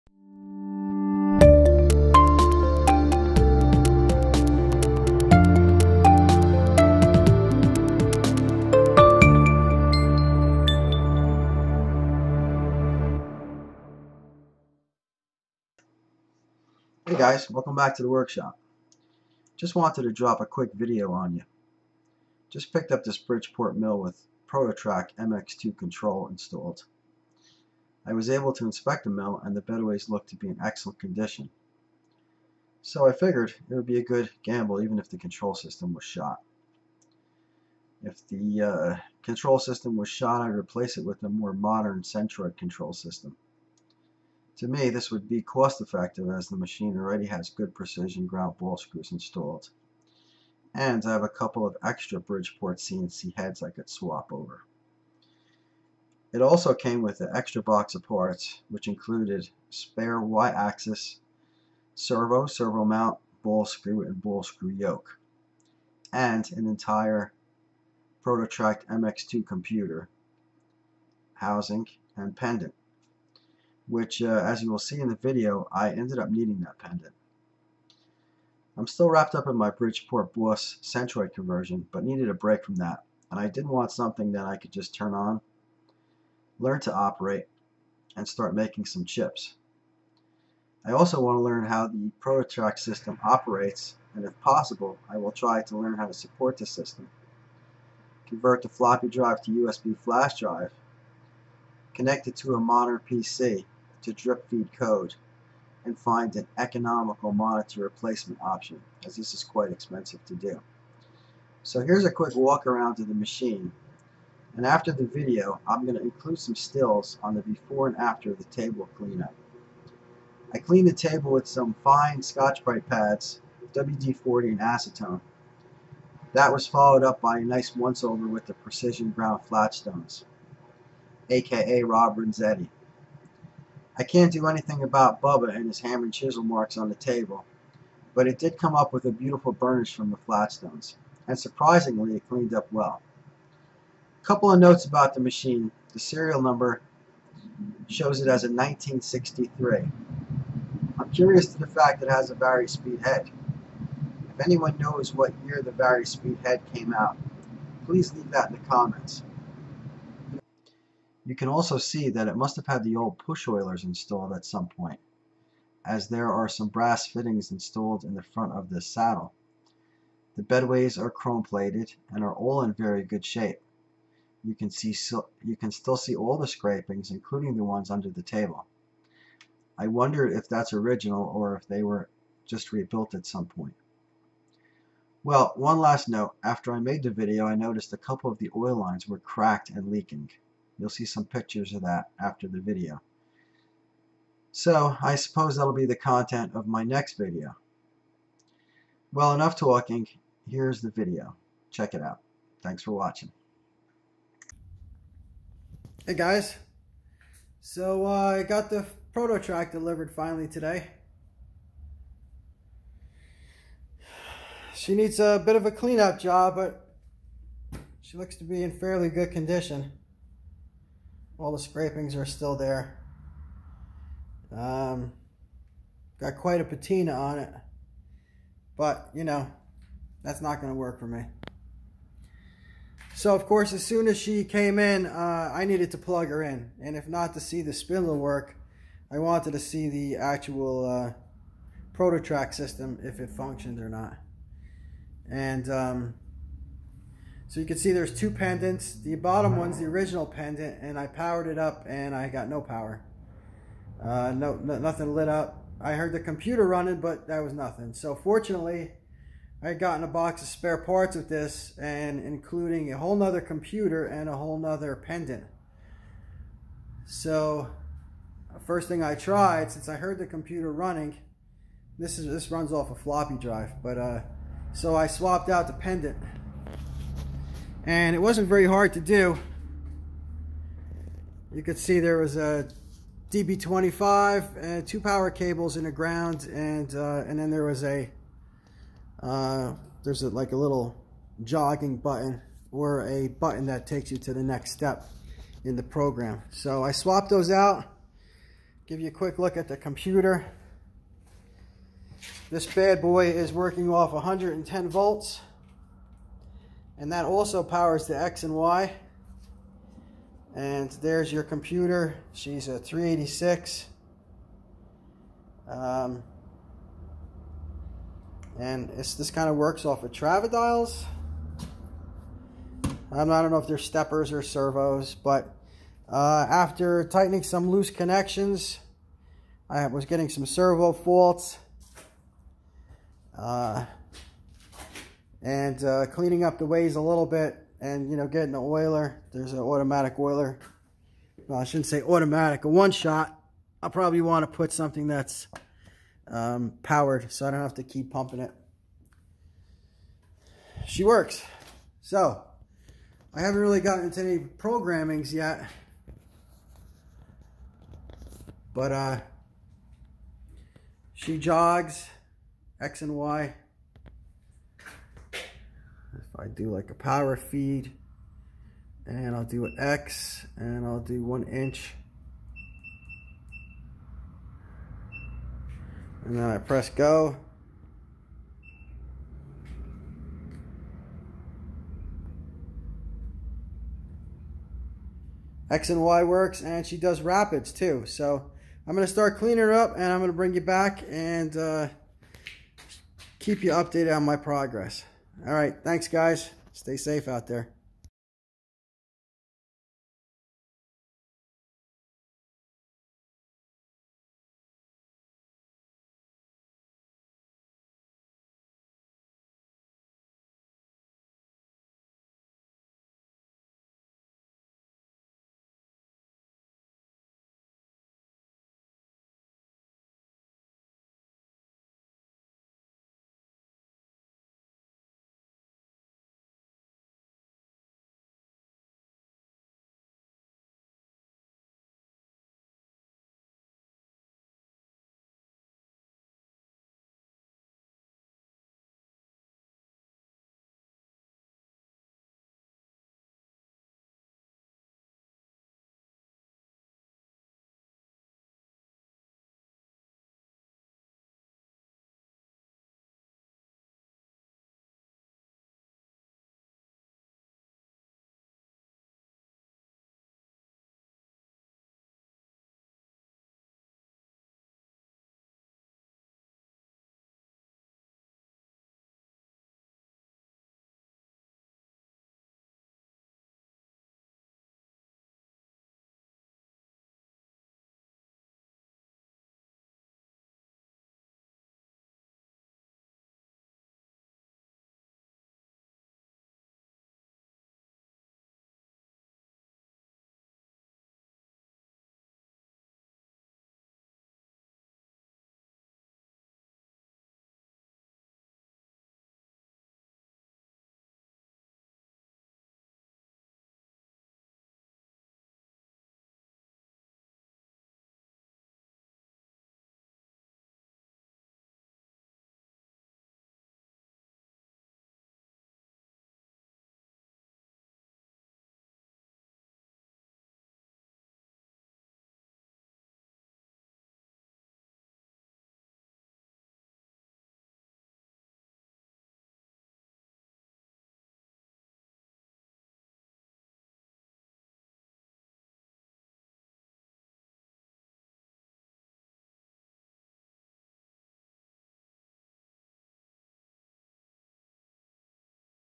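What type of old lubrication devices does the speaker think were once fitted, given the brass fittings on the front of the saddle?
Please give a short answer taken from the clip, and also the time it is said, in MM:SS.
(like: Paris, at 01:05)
push oilers, at 02:43.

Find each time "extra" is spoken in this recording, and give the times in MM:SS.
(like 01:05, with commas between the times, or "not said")
00:51, 00:57.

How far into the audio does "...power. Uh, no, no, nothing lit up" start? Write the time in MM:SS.
04:12.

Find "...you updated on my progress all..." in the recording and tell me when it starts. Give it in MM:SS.
06:33.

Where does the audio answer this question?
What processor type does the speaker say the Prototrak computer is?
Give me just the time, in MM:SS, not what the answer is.
05:12.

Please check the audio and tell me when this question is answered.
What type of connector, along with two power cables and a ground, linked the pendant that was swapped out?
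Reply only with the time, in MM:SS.
04:43.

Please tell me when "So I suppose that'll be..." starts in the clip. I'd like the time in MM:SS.
03:14.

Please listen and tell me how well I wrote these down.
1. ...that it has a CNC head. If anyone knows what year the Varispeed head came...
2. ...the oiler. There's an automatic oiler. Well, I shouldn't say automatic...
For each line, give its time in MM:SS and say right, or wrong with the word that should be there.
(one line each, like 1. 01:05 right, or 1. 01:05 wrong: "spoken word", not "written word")
1. 02:31 wrong: "Varispeed", not "CNC"
2. 05:38 right.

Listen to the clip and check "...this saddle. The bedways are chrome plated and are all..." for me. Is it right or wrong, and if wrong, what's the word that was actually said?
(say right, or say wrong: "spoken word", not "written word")
right.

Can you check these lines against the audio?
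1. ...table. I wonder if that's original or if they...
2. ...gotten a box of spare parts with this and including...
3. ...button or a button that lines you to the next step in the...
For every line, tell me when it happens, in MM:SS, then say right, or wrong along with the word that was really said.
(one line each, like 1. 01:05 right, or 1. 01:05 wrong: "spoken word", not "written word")
1. 02:58 right
2. 04:19 right
3. 04:51 wrong: "takes", not "lines".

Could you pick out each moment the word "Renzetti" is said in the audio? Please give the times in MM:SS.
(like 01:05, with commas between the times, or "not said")
02:12.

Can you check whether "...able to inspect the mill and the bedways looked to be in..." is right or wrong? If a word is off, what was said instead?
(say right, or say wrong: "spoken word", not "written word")
right.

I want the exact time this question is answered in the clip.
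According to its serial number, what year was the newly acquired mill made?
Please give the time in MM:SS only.
02:28.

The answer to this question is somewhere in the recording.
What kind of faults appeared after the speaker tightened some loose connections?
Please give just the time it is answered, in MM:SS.
05:30.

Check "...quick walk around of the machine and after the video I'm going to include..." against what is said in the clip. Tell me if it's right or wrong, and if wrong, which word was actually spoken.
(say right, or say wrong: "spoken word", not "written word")
right.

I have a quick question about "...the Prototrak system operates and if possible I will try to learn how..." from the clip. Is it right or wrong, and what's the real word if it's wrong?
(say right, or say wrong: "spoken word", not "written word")
right.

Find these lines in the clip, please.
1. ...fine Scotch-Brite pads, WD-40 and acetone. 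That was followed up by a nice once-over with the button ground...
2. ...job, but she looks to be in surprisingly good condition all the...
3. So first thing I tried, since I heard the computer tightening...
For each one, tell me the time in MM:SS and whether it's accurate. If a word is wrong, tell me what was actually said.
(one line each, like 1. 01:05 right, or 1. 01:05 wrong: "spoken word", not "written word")
1. 02:01 wrong: "precision", not "button"
2. 03:36 wrong: "fairly", not "surprisingly"
3. 04:27 wrong: "running", not "tightening".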